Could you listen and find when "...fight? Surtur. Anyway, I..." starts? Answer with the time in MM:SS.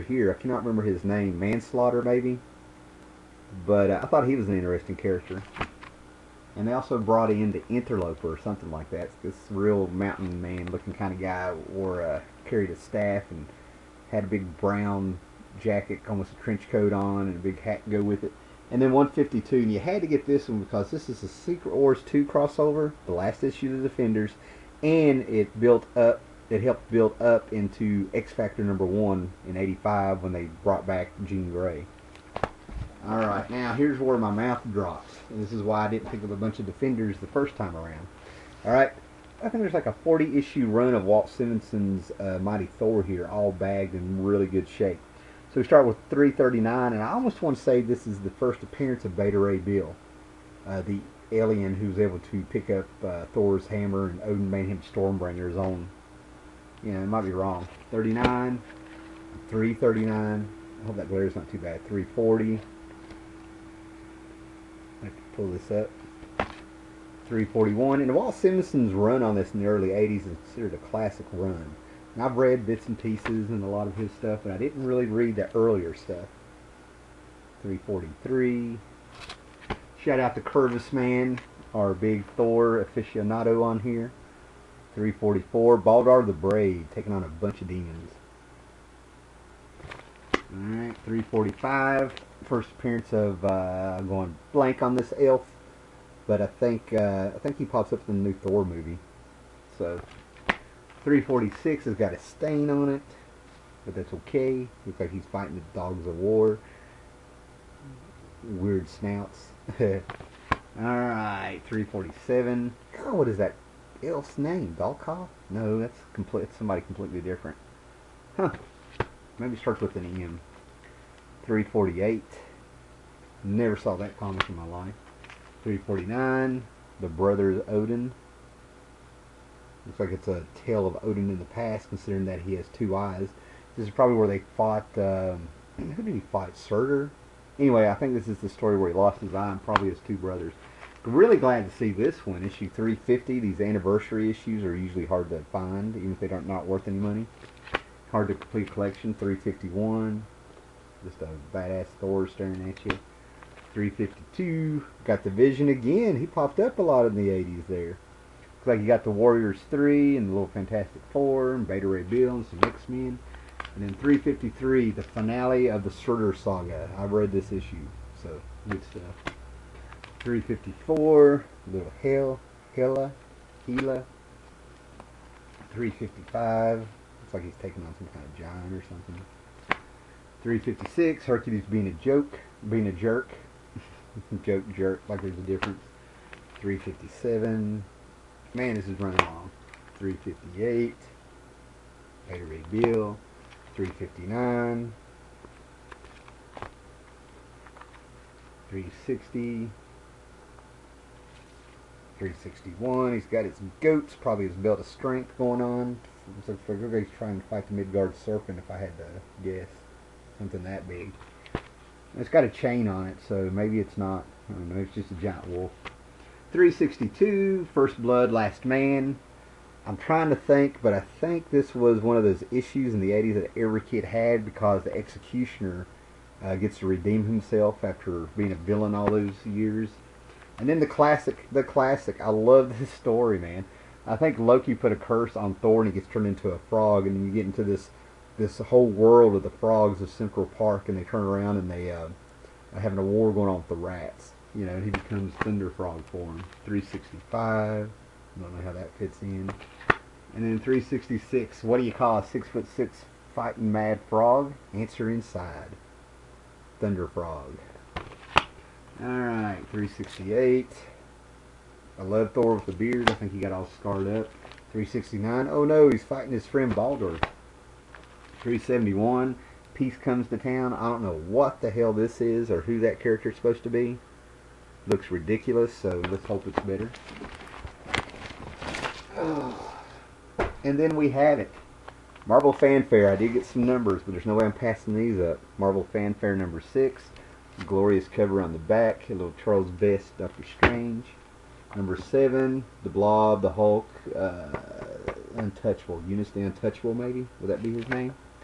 02:16.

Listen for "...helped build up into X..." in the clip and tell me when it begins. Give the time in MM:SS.
00:26.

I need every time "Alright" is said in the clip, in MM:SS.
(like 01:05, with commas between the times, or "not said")
01:30, 04:19.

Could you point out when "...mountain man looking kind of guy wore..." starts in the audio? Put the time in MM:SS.
00:09.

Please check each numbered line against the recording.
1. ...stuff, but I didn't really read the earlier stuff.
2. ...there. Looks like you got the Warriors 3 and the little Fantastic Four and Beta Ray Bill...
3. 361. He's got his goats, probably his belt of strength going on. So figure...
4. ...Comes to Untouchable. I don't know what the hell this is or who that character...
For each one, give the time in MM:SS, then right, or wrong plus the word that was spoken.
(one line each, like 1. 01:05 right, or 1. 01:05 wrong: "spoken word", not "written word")
1. 01:14 right
2. 02:37 right
3. 03:22 right
4. 04:29 wrong: "Town", not "Untouchable".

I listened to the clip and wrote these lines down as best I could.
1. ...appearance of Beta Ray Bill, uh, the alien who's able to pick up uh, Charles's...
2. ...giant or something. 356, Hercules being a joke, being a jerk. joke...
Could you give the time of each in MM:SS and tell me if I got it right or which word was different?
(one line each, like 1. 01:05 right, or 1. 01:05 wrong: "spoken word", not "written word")
1. 00:48 wrong: "Thor", not "Charles"
2. 02:58 right.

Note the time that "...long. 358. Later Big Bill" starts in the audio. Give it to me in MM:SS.
03:09.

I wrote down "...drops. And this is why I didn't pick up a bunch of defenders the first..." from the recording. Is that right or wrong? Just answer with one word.
right.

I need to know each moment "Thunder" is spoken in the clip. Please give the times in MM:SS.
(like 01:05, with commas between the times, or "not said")
04:05, 04:16.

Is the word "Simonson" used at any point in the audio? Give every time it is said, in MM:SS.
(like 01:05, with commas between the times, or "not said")
00:41, 01:08.